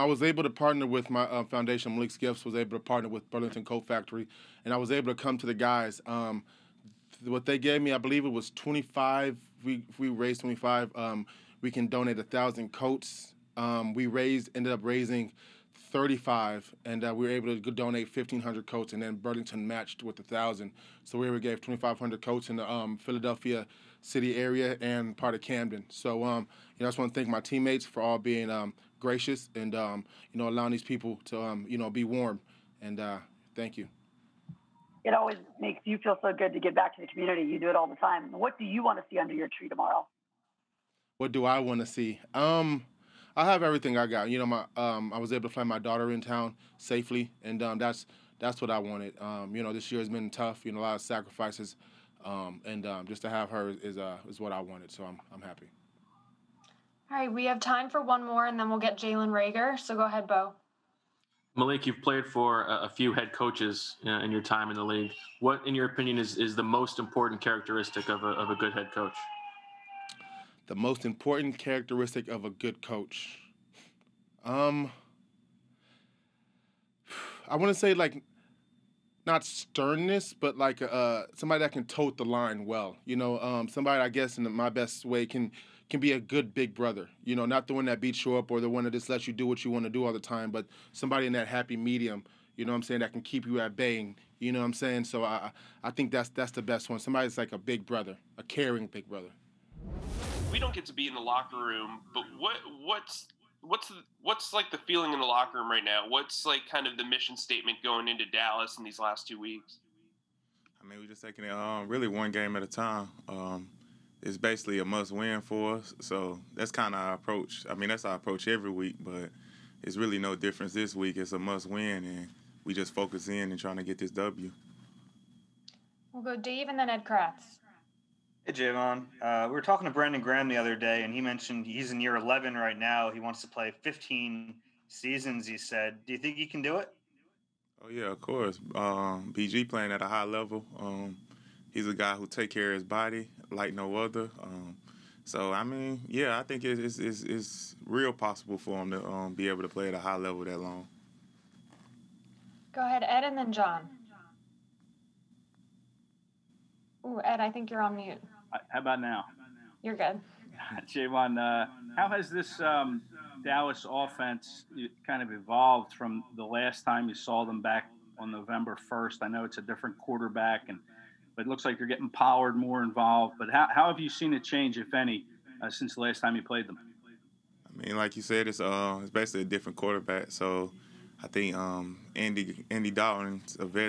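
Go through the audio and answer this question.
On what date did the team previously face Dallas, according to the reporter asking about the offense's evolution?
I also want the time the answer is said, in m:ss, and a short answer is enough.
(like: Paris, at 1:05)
November 1st, at 2:48.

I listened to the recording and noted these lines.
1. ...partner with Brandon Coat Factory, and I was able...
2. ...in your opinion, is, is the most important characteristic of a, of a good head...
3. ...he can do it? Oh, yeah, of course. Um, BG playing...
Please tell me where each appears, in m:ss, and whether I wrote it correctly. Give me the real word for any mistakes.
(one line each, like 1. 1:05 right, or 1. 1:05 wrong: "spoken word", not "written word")
1. 0:02 wrong: "Burlington", not "Brandon"
2. 1:05 right
3. 2:16 right.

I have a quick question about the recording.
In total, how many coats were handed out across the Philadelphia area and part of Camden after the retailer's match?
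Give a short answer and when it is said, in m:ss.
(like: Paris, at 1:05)
2,500, at 0:21.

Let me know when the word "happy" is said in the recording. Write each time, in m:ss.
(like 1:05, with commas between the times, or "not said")
0:55, 1:31.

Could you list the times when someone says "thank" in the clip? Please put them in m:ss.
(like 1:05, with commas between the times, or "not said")
0:27, 0:33.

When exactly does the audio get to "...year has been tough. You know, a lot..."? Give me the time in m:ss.
0:49.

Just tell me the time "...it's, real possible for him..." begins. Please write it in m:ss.
2:27.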